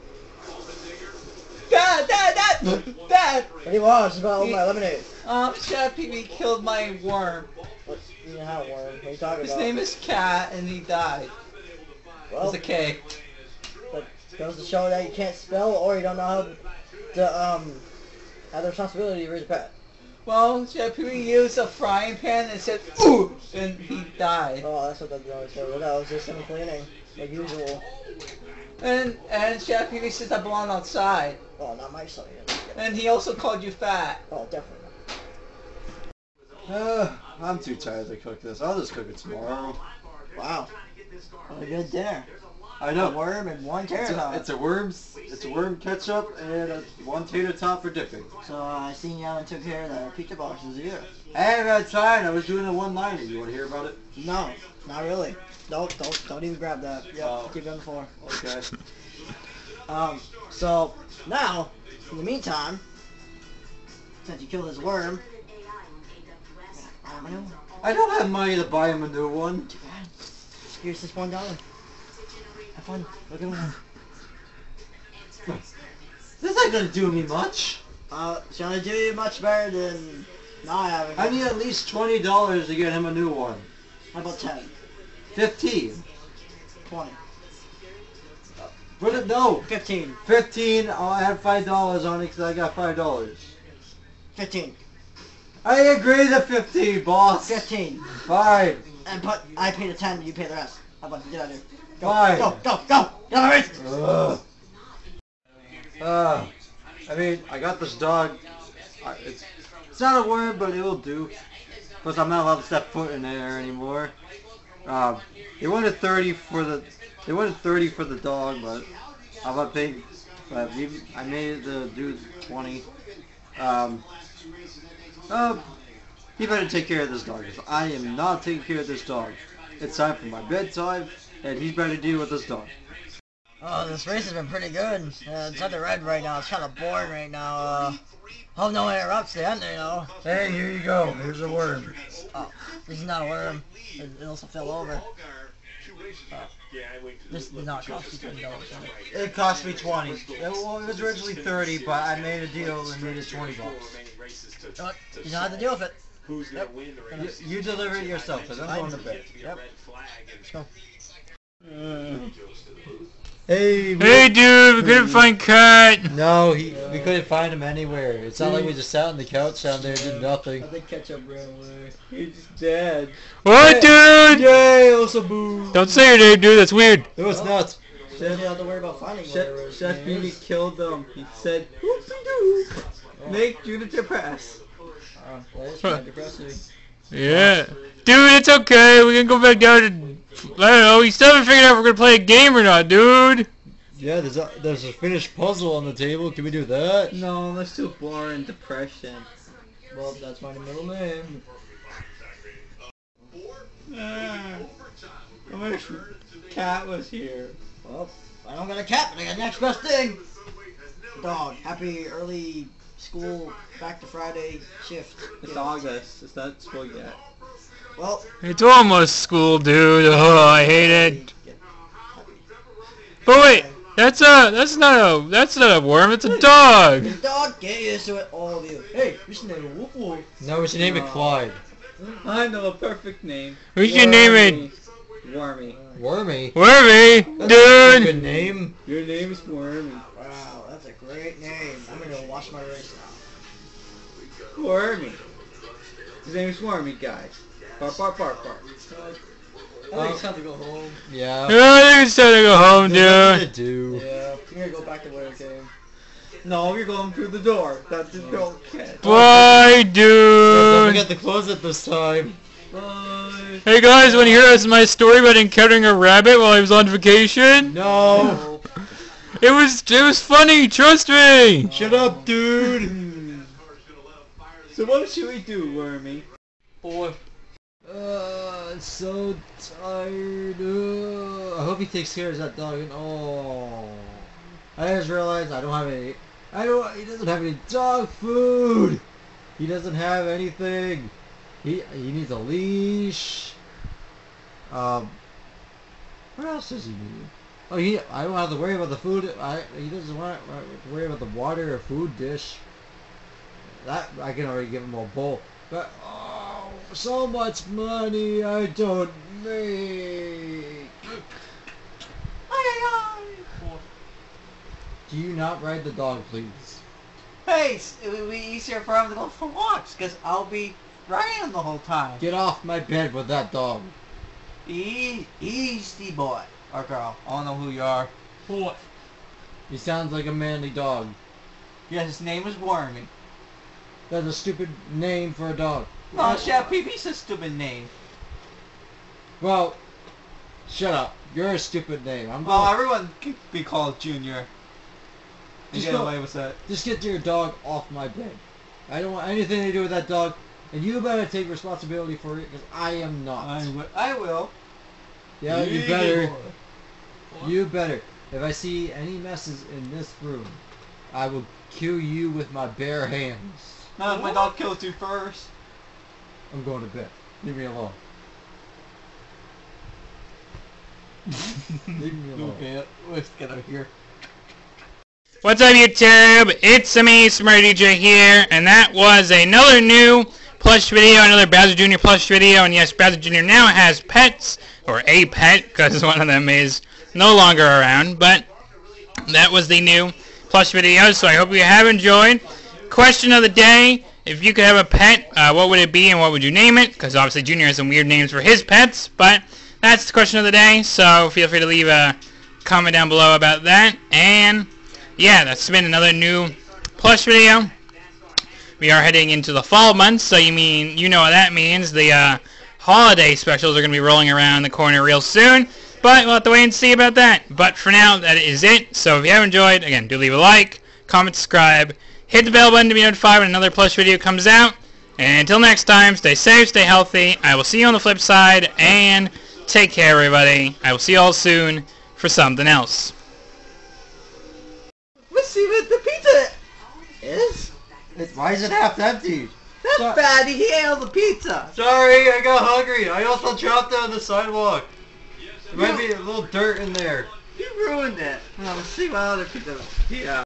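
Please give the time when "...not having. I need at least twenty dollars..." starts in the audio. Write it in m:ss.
1:20.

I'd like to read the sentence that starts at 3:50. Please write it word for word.
No, we should name it Clyde.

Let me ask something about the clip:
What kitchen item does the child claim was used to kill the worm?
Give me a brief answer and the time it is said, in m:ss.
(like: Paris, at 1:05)
frying pan, at 0:21.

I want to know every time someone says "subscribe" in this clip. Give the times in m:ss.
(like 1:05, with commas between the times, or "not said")
7:01.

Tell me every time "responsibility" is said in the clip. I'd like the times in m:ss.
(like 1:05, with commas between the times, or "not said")
0:18, 5:51.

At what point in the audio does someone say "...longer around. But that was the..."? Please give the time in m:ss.
6:27.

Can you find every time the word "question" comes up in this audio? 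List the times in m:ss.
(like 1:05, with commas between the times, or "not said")
6:32, 6:40.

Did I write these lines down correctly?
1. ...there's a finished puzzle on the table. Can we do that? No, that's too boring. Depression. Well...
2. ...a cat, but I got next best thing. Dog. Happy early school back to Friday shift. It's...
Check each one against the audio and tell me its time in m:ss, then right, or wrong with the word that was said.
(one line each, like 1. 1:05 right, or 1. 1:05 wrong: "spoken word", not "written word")
1. 3:14 right
2. 3:28 right.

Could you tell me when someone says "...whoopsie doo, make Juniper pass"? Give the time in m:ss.
3:01.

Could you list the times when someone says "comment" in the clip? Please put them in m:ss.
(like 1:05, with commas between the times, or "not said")
6:42, 7:01.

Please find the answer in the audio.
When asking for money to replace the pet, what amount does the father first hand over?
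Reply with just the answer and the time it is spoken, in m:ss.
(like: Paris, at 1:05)
$1, at 1:11.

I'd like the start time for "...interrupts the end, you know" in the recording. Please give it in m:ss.
2:18.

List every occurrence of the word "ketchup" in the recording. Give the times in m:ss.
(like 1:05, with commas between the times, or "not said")
0:45, 2:50.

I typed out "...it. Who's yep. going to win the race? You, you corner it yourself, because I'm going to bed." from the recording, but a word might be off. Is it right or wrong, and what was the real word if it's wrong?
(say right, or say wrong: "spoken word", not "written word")
wrong: "deliver", not "corner".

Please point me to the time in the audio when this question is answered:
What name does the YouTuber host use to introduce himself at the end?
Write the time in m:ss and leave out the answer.
6:17.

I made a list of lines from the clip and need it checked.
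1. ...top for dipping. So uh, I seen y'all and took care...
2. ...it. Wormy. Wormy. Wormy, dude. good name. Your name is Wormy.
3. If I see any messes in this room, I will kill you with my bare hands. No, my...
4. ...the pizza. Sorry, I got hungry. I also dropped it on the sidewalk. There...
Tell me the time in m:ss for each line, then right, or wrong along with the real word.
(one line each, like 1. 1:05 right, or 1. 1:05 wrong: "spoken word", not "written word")
1. 0:47 right
2. 3:54 right
3. 5:58 right
4. 7:21 right.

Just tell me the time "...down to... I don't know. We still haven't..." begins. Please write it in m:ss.
3:09.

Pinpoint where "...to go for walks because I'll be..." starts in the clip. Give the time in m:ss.
5:19.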